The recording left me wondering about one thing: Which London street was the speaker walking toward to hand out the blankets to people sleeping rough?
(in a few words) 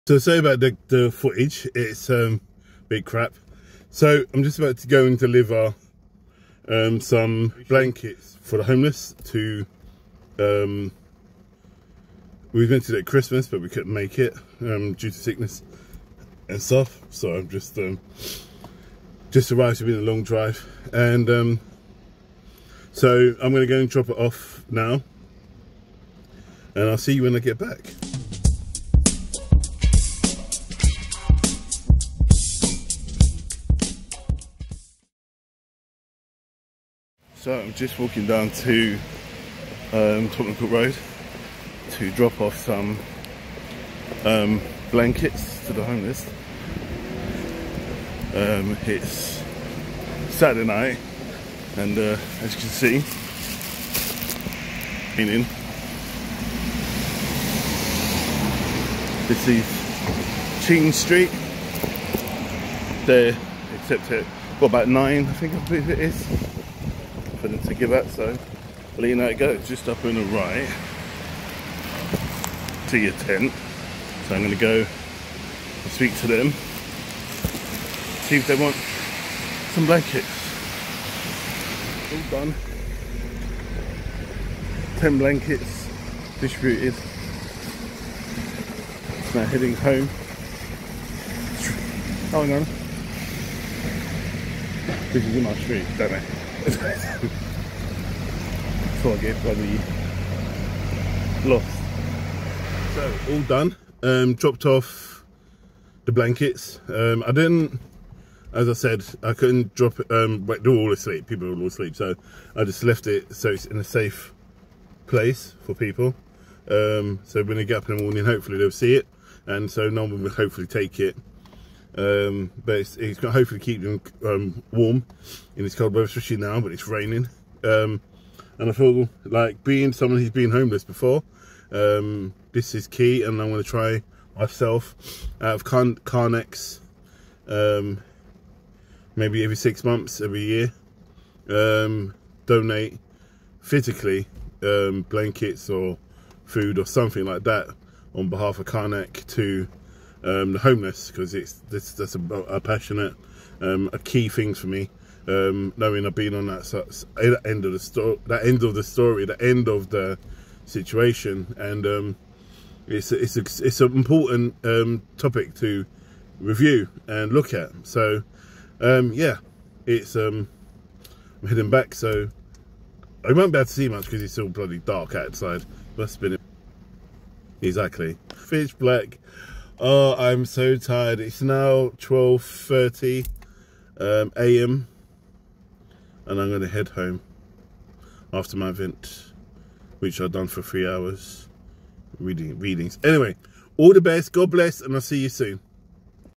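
Tottenham Court Road.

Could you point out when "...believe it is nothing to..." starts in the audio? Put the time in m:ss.
1:05.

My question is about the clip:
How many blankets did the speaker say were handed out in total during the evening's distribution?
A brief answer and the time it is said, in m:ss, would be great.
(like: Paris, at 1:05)
10, at 1:24.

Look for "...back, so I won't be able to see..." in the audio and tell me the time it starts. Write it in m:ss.
2:51.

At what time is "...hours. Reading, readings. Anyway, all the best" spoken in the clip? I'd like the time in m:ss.
3:10.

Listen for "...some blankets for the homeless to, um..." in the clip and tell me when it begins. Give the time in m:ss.
0:06.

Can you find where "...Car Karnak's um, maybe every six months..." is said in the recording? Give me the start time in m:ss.
2:15.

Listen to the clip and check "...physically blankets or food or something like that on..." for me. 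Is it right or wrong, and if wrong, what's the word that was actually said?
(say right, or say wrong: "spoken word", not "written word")
right.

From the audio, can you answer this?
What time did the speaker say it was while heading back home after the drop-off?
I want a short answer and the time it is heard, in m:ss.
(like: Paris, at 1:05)
12:30 a.m., at 3:01.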